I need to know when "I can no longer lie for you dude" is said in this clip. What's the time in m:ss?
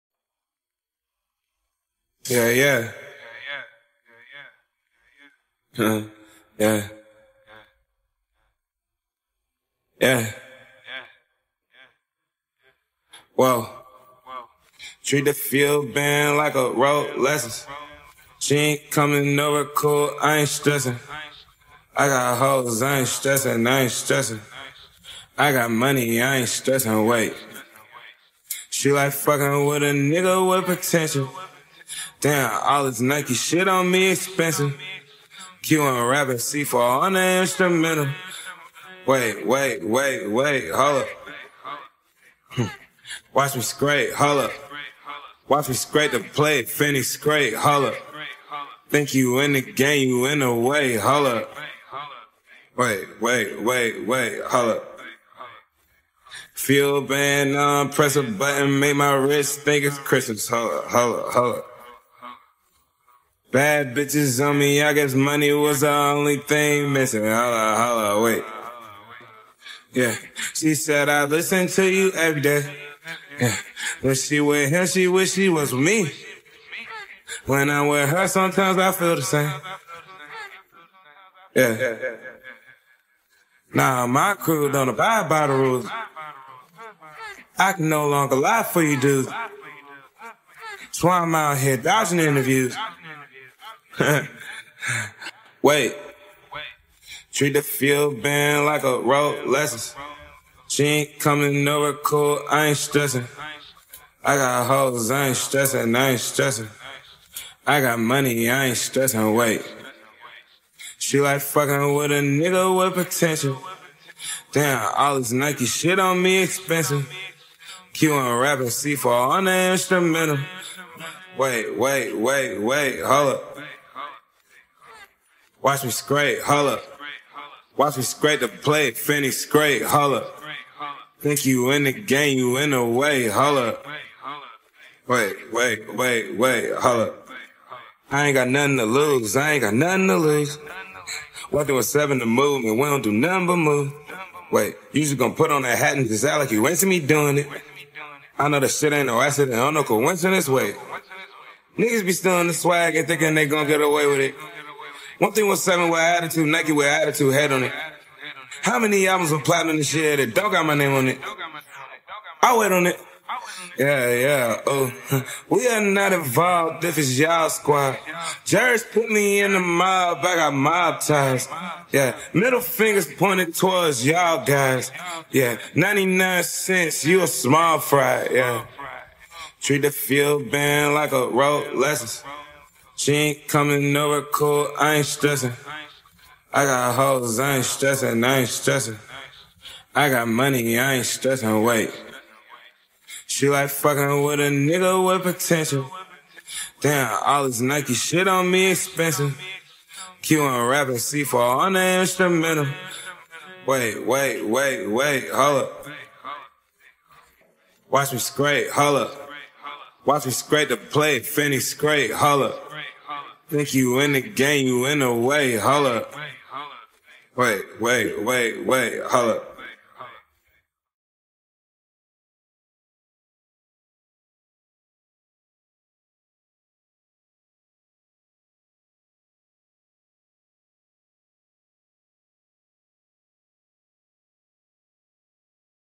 1:27.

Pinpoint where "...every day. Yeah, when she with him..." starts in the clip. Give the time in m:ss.
1:12.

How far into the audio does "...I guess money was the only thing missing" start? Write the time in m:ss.
1:04.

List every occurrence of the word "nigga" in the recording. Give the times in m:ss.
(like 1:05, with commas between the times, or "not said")
0:29, 1:52, 2:31, 3:14.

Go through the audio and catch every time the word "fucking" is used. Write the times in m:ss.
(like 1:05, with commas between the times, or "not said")
0:29, 1:51, 3:13.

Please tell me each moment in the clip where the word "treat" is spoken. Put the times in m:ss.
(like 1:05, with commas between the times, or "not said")
0:15, 1:37, 2:59.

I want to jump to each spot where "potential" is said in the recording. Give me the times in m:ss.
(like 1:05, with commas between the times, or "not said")
0:30, 1:53, 3:15.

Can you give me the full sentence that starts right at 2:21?
What through seven to move, and we don't do nothing but move.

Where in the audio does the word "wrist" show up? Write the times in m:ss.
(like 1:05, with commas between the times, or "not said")
0:59.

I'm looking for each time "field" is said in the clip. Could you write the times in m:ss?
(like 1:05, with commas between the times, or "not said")
0:15, 1:37, 2:59.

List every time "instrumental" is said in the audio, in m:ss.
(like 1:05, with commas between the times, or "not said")
0:37, 1:59, 3:22.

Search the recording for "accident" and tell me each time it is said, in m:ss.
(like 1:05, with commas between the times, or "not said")
2:29.